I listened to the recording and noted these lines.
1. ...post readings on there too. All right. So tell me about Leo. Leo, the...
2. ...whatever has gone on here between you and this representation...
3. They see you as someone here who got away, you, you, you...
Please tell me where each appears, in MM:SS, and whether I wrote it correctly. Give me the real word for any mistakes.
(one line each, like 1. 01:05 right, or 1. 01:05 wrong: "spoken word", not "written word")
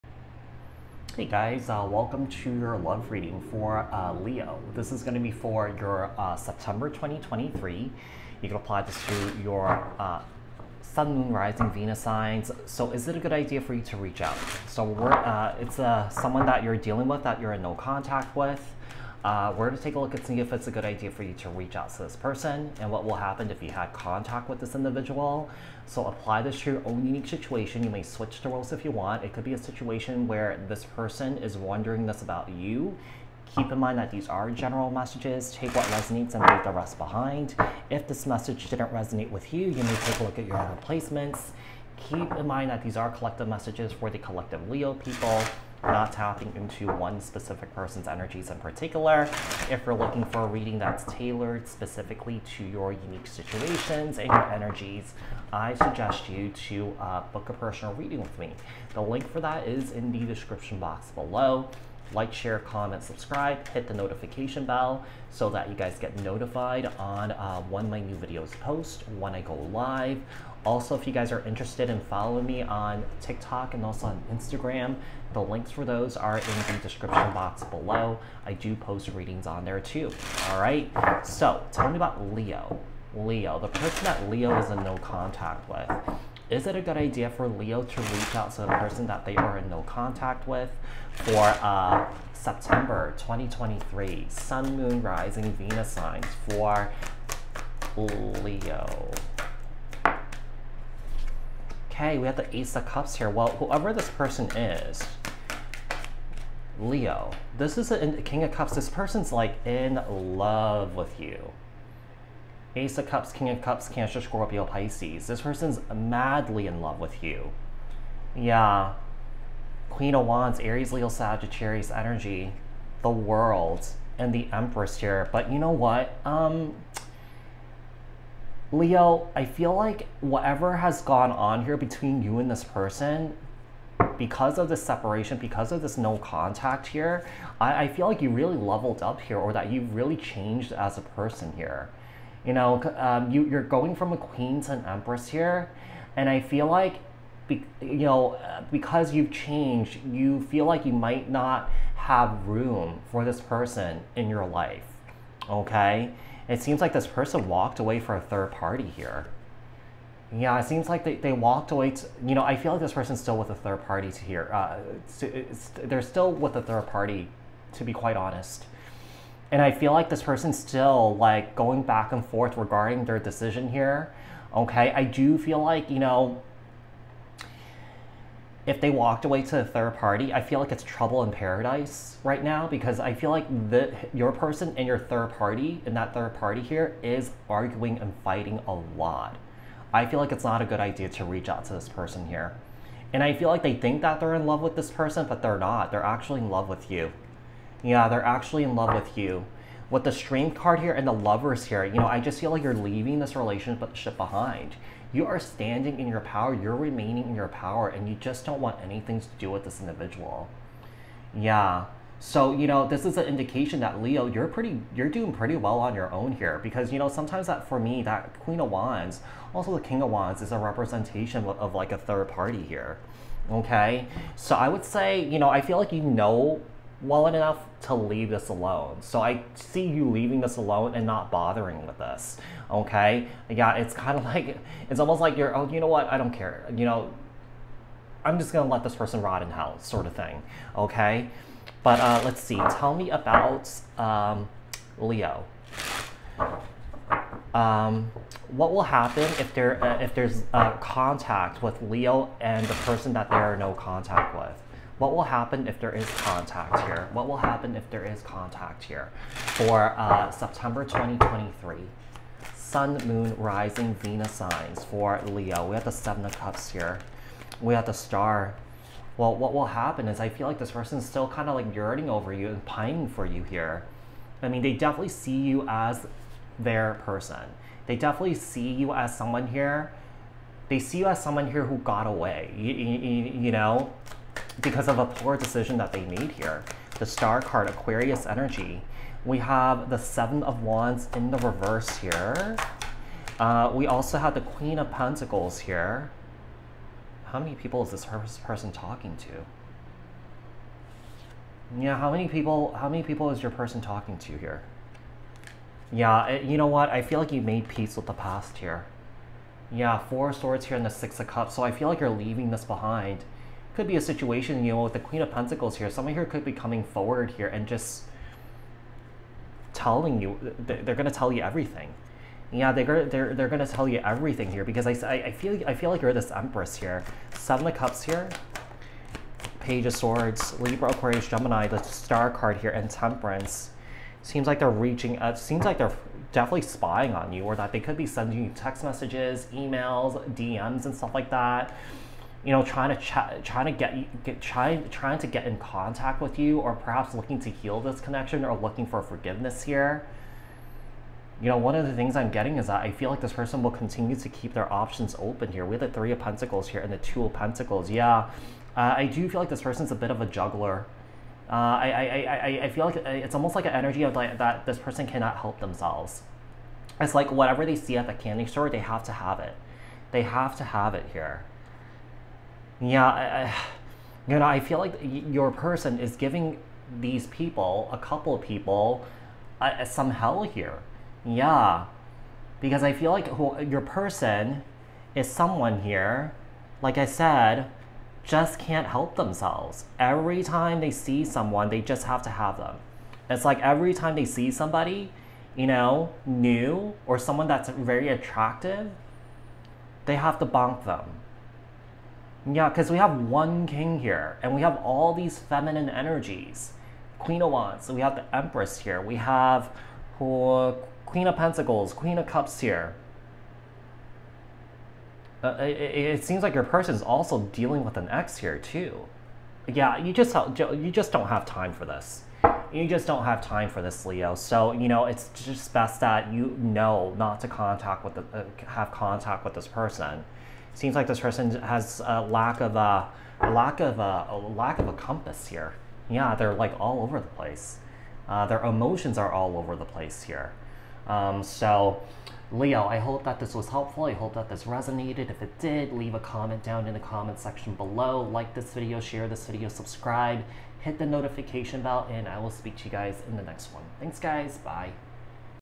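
1. 01:18 right
2. 02:10 wrong: "person", not "representation"
3. 04:40 right.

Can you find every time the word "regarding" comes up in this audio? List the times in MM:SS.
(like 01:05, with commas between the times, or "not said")
02:52.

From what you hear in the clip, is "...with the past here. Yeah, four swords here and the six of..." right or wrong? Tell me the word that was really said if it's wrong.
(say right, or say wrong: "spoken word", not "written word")
right.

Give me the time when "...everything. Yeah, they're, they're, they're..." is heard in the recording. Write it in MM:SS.
05:21.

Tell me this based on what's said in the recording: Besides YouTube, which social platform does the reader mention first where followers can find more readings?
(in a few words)
TikTok.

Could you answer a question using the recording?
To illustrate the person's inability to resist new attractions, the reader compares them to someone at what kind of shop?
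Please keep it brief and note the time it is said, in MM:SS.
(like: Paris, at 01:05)
candy store, at 06:08.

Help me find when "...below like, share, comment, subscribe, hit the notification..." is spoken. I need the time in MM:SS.
01:01.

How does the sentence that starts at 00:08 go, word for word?
You can apply this to your uh, Sun, Moon, Rising, Venus signs.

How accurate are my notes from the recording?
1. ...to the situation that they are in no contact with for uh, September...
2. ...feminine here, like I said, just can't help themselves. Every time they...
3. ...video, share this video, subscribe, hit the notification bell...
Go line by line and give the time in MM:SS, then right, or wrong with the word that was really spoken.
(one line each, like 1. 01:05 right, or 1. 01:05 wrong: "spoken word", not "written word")
1. 01:28 wrong: "person", not "situation"
2. 06:25 wrong: "someone", not "feminine"
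3. 07:28 right.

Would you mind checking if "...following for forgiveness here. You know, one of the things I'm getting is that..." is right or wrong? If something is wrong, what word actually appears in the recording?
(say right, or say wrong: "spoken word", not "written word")
wrong: "looking", not "following".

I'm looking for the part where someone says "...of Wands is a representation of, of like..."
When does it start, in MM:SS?
03:40.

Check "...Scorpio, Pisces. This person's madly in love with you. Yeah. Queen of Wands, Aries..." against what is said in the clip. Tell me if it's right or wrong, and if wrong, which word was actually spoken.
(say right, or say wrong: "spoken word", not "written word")
right.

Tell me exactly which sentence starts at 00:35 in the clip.
Take what resonates and leave the rest behind.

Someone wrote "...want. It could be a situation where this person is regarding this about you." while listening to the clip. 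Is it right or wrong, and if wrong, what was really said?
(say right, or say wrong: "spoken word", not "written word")
wrong: "wondering", not "regarding".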